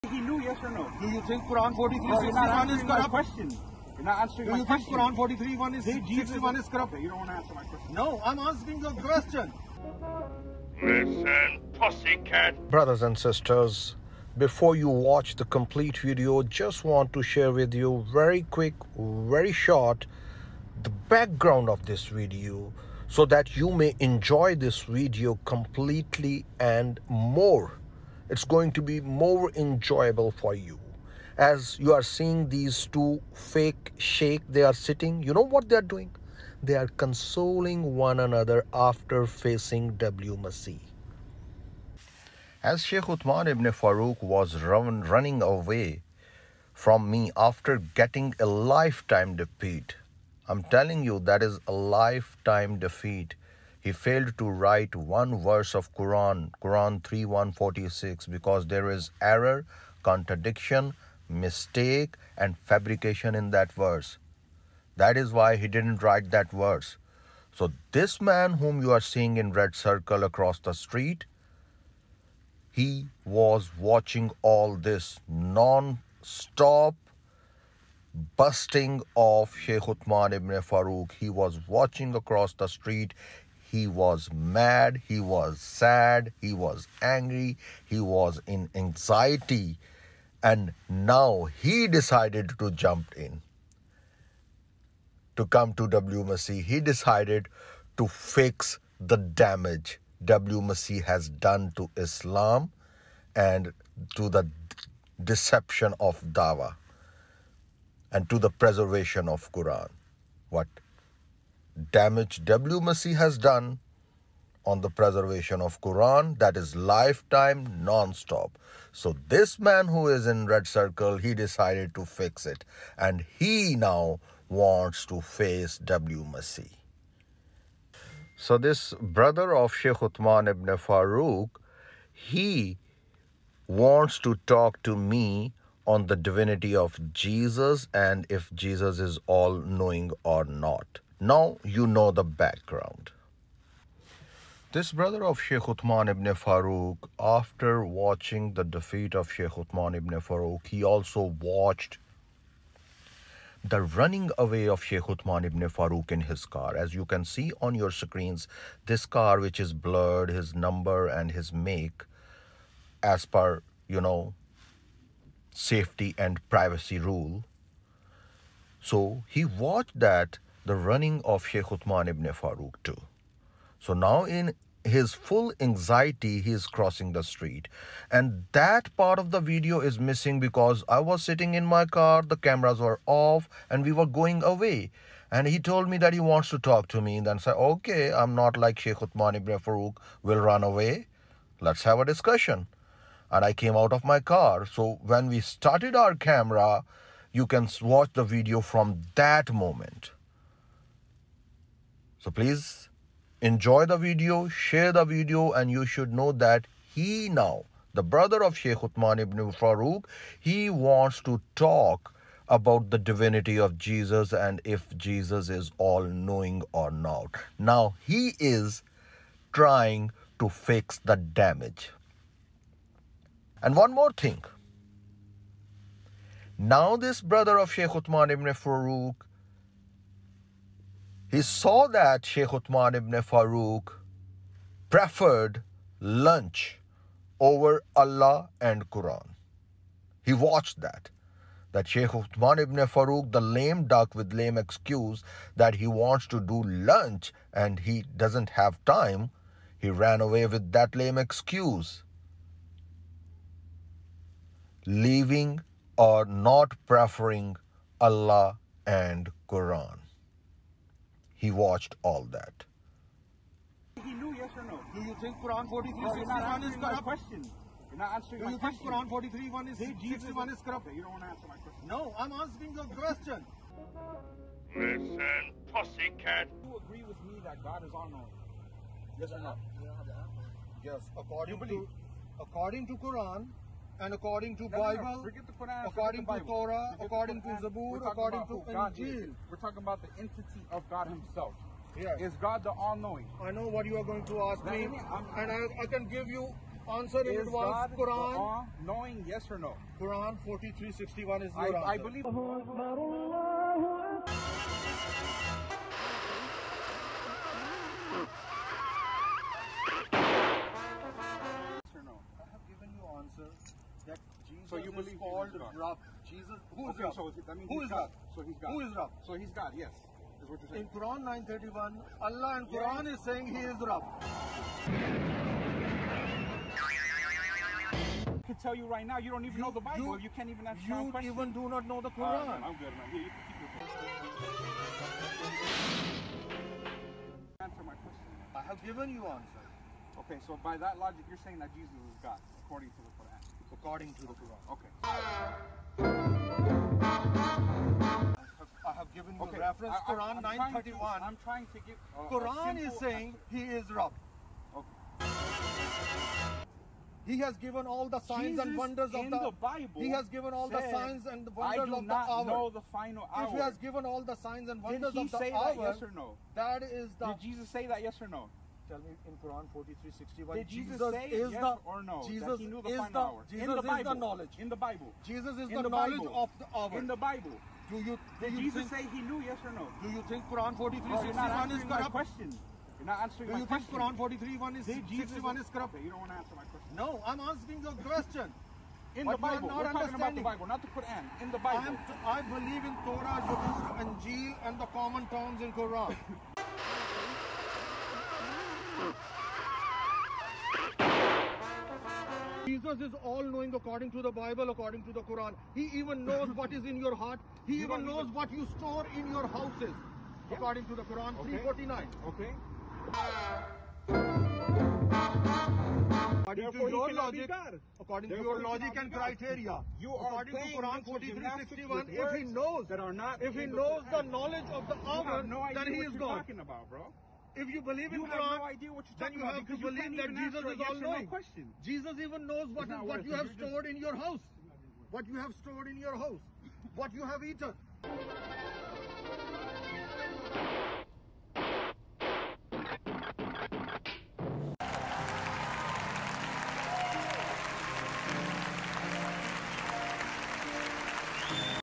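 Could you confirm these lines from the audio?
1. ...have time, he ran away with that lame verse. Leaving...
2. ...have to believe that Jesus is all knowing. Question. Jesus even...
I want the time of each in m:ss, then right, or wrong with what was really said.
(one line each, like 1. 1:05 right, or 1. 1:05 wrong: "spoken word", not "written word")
1. 4:08 wrong: "excuse", not "verse"
2. 7:09 right.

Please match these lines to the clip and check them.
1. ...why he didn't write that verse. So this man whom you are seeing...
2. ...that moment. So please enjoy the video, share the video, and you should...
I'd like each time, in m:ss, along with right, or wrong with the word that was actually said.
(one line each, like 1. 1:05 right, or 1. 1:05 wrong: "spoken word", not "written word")
1. 1:05 right
2. 3:19 right.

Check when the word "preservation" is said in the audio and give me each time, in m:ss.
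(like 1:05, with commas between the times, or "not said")
1:48, 1:54.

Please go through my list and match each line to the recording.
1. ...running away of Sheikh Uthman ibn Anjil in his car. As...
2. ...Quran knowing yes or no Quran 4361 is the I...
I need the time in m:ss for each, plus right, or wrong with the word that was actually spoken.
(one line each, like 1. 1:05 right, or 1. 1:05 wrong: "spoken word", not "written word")
1. 2:33 wrong: "Farooq", not "Anjil"
2. 4:57 right.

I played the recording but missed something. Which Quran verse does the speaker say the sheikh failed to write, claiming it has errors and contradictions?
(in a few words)
Quran 3:146.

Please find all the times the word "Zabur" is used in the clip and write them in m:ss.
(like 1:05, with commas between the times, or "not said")
4:47, 6:33.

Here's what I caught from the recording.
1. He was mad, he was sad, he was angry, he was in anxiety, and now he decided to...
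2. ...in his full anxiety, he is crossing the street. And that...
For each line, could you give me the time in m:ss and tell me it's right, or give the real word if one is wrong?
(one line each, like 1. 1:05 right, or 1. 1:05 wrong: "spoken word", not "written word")
1. 1:23 right
2. 2:54 right.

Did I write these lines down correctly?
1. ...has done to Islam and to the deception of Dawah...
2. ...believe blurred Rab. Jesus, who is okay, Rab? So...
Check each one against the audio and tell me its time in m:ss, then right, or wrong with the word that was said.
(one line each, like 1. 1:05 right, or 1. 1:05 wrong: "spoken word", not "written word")
1. 1:41 right
2. 5:14 wrong: "called", not "blurred".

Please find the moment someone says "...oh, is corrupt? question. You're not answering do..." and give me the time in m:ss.
6:21.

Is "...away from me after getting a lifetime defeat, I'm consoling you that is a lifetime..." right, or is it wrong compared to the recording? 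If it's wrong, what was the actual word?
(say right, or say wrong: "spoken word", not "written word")
wrong: "telling", not "consoling".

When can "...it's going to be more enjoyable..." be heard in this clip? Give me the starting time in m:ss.
0:28.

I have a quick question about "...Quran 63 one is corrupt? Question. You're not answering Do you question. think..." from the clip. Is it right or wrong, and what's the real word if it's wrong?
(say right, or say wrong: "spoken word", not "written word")
wrong: "43", not "63".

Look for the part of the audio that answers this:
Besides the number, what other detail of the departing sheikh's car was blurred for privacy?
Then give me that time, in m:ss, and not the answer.
2:41.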